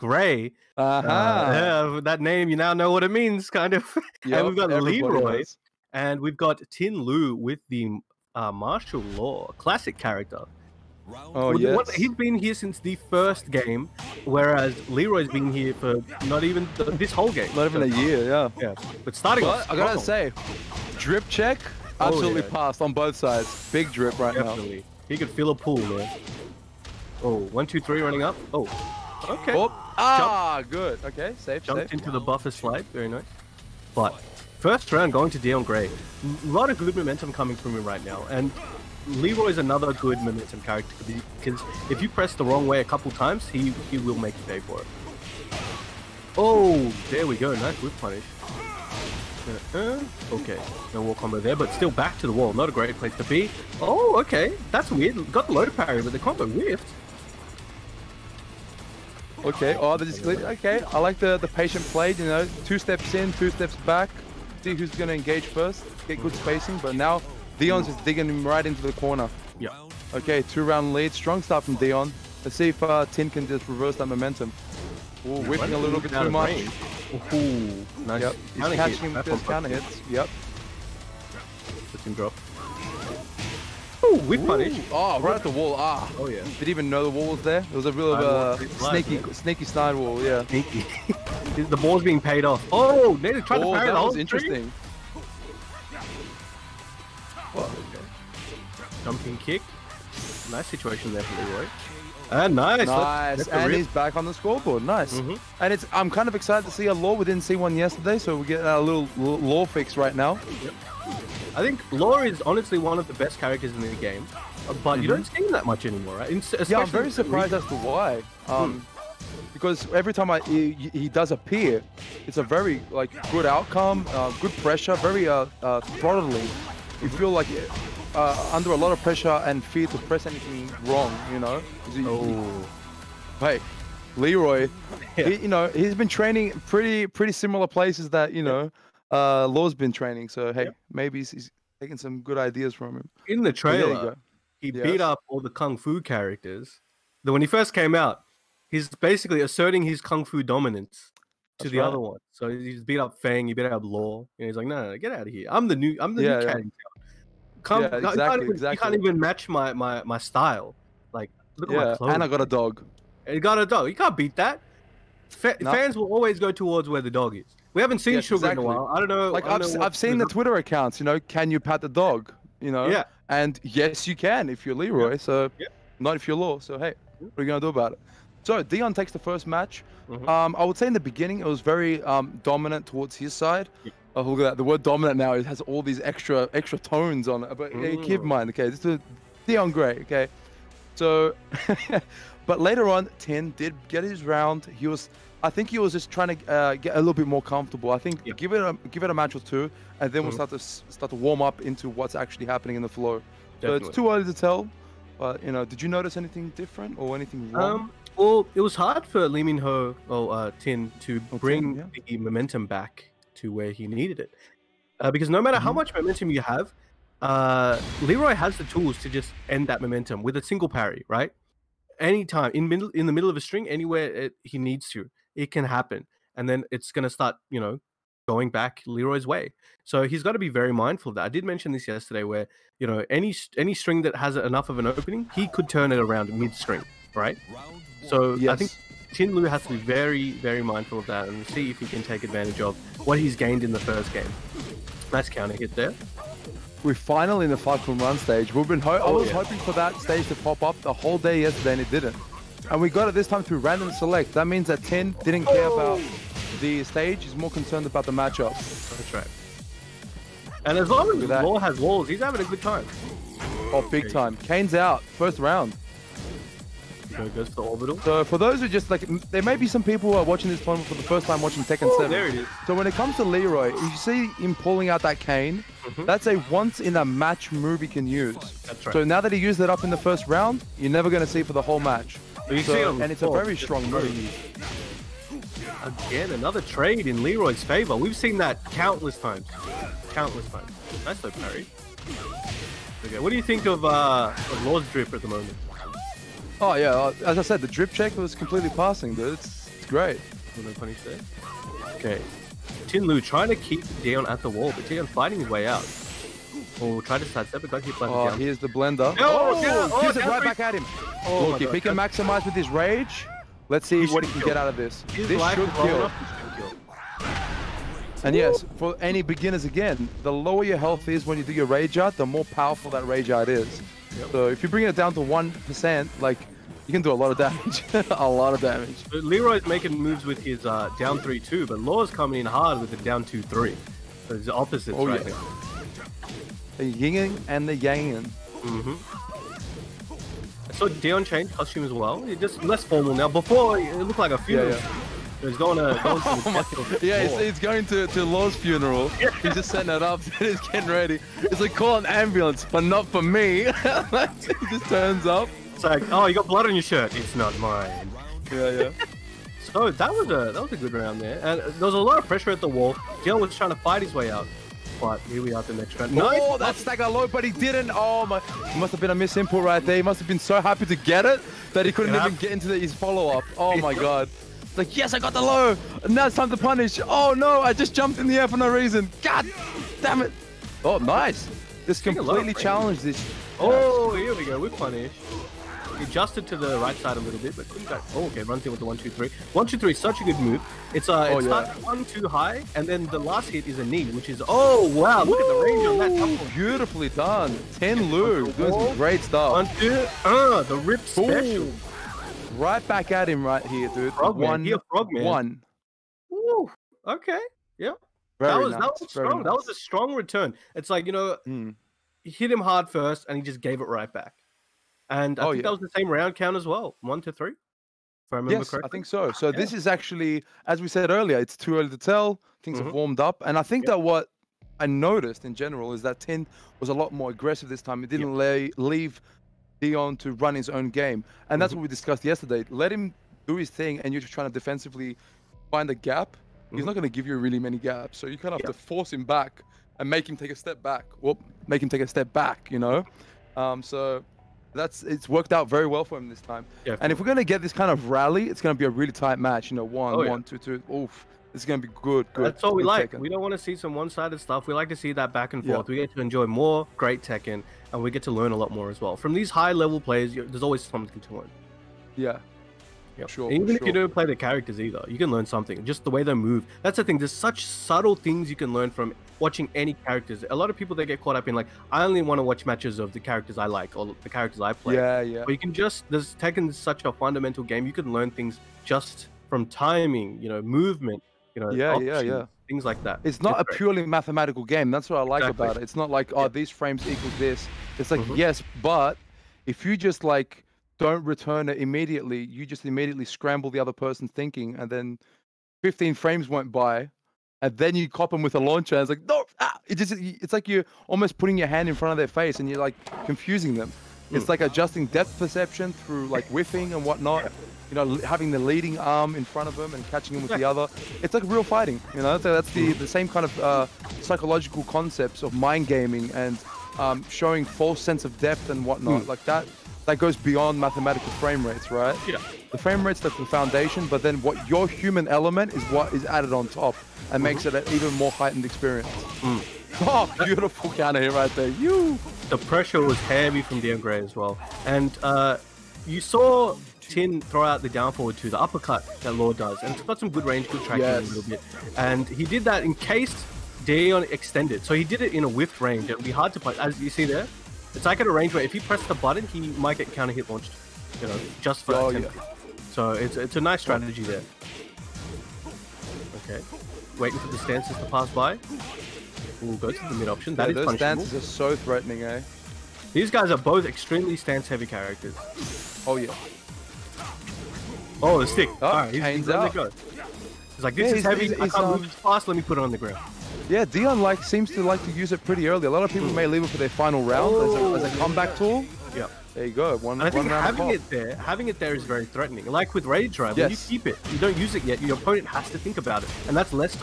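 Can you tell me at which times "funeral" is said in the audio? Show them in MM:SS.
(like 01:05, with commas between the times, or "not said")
05:44, 05:48.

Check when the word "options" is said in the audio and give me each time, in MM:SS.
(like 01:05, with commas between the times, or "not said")
08:01, 09:20.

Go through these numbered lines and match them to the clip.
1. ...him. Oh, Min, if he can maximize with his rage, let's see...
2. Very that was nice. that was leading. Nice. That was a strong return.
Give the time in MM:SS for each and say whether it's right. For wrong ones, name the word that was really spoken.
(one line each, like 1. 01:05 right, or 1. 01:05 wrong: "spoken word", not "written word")
1. 05:10 wrong: "Look", not "Min"
2. 06:48 wrong: "strong", not "leading".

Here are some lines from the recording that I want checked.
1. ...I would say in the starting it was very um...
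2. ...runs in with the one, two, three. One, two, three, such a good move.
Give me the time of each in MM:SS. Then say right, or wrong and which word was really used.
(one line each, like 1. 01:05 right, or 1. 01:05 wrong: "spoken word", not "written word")
1. 03:00 wrong: "beginning", not "starting"
2. 06:28 right.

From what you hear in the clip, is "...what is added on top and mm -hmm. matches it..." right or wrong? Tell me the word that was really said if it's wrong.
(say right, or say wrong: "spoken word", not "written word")
wrong: "makes", not "matches".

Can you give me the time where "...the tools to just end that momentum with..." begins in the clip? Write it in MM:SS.
03:38.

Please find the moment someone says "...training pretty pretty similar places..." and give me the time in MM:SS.
02:16.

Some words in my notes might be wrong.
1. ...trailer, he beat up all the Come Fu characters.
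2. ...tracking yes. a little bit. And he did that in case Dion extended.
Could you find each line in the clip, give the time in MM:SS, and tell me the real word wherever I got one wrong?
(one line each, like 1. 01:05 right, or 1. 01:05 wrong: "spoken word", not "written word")
1. 02:23 wrong: "Kung", not "Come"
2. 09:00 right.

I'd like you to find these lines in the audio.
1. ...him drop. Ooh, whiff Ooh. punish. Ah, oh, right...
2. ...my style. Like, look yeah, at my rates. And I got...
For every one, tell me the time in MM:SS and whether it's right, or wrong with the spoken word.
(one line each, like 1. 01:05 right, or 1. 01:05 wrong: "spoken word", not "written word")
1. 01:22 right
2. 02:40 wrong: "clothes", not "rates".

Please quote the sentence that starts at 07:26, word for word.
Yeah, and if we're gonna get this kind of rally, it's gonna be a really tight match.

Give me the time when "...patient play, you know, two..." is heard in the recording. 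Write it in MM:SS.
01:01.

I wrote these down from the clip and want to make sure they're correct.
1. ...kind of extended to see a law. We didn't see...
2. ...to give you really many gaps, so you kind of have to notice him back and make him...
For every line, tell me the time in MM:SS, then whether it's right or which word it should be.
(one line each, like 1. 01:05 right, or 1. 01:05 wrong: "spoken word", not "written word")
1. 01:46 wrong: "excited", not "extended"
2. 07:17 wrong: "force", not "notice".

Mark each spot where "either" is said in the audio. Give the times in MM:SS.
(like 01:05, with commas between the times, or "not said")
07:44.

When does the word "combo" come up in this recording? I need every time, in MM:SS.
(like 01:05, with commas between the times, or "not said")
00:51, 00:56.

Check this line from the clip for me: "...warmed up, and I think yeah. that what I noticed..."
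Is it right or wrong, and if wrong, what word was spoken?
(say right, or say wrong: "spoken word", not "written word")
right.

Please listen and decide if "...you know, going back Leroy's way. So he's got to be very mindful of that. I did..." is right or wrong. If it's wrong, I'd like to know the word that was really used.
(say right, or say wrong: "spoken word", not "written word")
right.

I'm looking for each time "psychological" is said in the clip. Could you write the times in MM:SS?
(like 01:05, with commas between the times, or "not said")
08:34.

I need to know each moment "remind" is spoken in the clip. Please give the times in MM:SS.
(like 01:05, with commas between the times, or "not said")
not said.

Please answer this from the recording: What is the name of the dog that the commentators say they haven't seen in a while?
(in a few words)
Sugar.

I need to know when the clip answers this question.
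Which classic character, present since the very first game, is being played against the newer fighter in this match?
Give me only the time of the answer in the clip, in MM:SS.
00:08.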